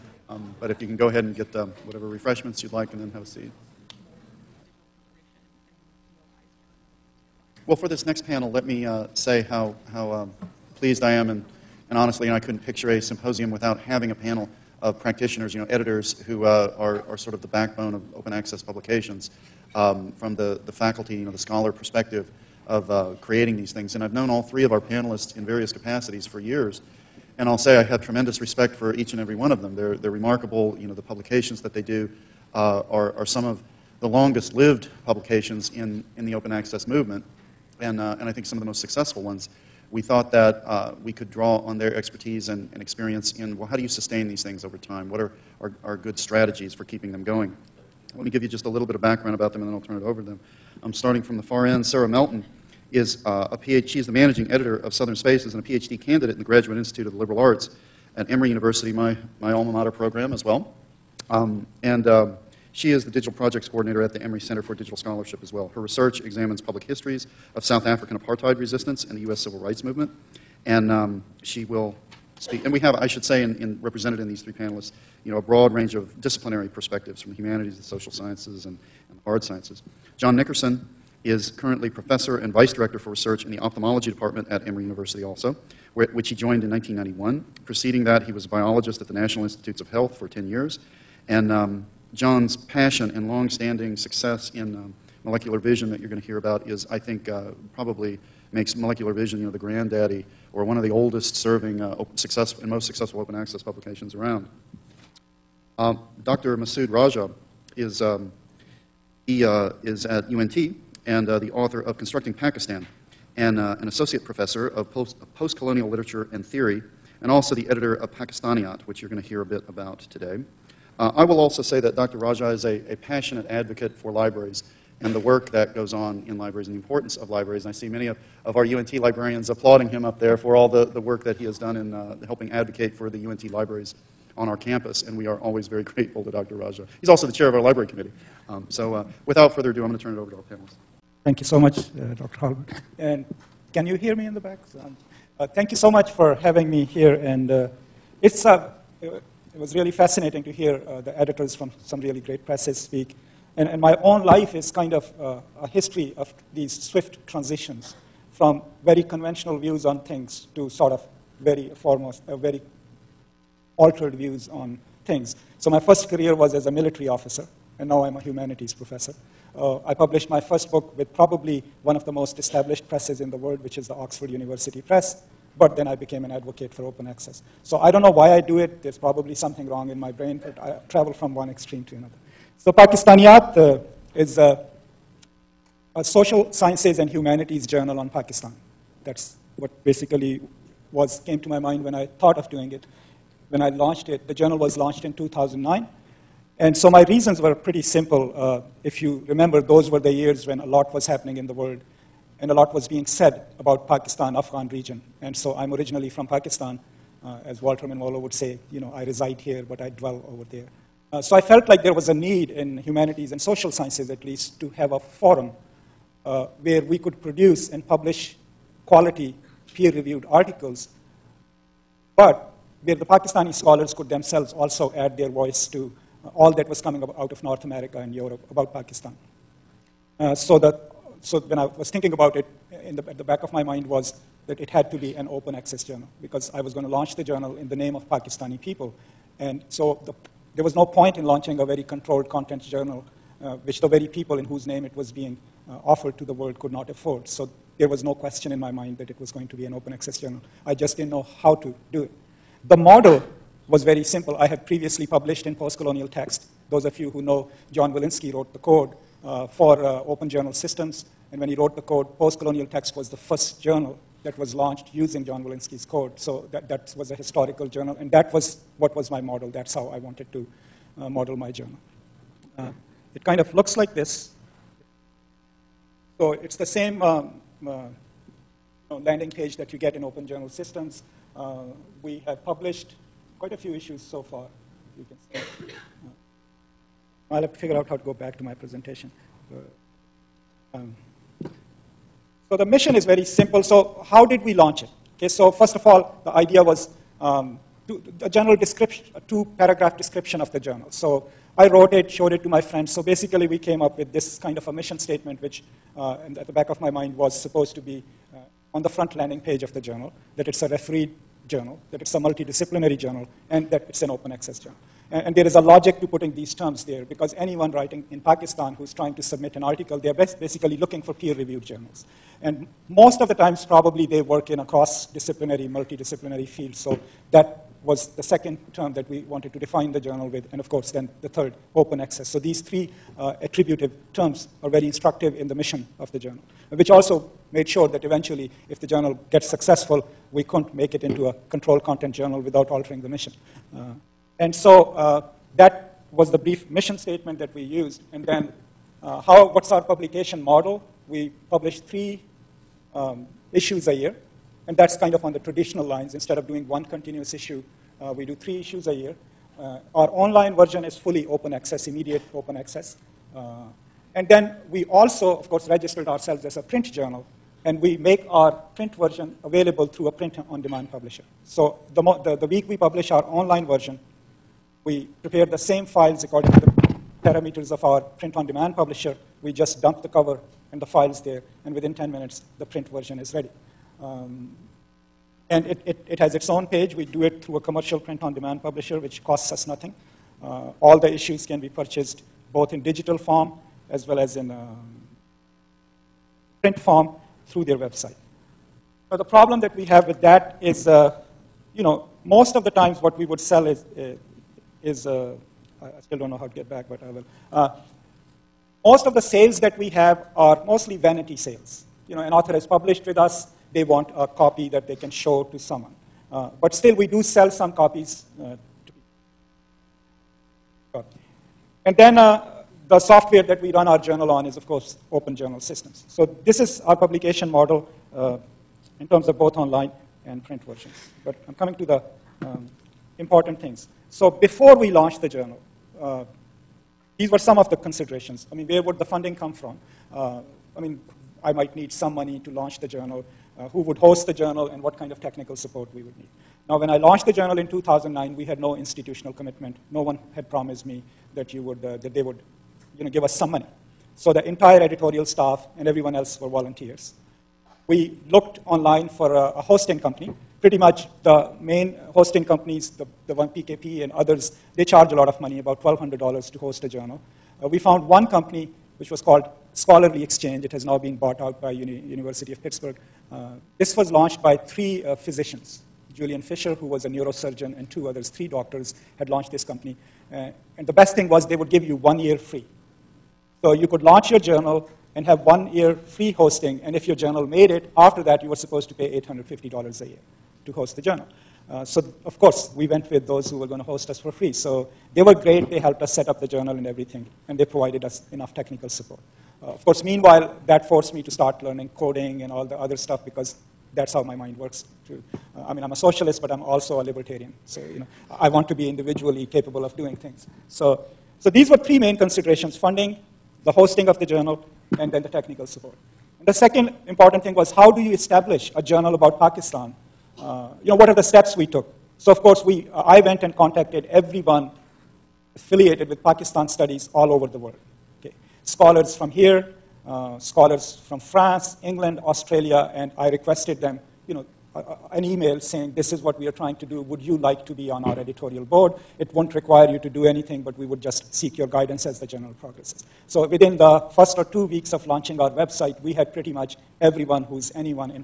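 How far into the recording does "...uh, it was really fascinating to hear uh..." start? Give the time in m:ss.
2:28.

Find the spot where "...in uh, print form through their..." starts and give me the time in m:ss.
6:34.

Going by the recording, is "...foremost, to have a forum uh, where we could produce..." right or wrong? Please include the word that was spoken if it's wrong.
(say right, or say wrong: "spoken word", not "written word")
wrong: "least", not "foremost".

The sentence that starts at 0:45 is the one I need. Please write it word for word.
What are, are, are good strategies for keeping them going?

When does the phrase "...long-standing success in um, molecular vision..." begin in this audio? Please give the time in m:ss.
1:33.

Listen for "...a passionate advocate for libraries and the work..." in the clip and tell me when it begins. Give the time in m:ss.
2:02.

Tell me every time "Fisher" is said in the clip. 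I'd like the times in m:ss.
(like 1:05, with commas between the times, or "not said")
7:56.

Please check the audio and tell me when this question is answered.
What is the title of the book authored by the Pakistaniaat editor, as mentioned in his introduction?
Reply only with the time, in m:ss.
1:51.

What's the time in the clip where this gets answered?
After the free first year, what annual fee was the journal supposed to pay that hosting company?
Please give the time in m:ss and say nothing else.
8:09.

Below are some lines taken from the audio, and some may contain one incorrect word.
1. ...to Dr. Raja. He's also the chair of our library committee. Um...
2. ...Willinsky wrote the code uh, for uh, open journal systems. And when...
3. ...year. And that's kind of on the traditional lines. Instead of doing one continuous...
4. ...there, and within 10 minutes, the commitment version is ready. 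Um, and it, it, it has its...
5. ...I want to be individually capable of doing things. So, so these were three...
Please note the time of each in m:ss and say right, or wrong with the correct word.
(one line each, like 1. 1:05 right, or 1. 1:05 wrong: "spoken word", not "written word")
1. 2:16 right
2. 4:17 right
3. 5:53 right
4. 6:21 wrong: "print", not "commitment"
5. 8:28 right.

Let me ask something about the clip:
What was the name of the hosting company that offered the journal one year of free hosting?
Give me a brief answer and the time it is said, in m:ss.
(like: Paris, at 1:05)
Scholarly Exchange, at 7:49.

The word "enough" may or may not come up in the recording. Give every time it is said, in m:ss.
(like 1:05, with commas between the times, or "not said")
8:18.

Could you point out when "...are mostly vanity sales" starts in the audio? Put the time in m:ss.
6:50.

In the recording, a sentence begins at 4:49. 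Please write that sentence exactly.
Uh, um, so the mission is very simple.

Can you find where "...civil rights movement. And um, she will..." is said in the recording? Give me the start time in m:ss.
1:09.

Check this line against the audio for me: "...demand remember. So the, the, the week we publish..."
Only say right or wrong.
wrong.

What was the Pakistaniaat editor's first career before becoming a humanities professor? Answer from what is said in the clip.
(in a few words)
Military officer.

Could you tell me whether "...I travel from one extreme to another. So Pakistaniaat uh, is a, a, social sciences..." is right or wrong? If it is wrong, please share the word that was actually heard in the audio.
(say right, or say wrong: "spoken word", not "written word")
right.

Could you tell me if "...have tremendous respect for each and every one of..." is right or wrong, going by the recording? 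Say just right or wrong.
right.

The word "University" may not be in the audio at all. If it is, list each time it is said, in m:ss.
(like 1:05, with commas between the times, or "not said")
0:58, 1:24, 2:54, 7:51.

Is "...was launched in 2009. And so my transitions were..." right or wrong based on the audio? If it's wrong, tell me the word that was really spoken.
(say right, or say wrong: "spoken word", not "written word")
wrong: "reasons", not "transitions".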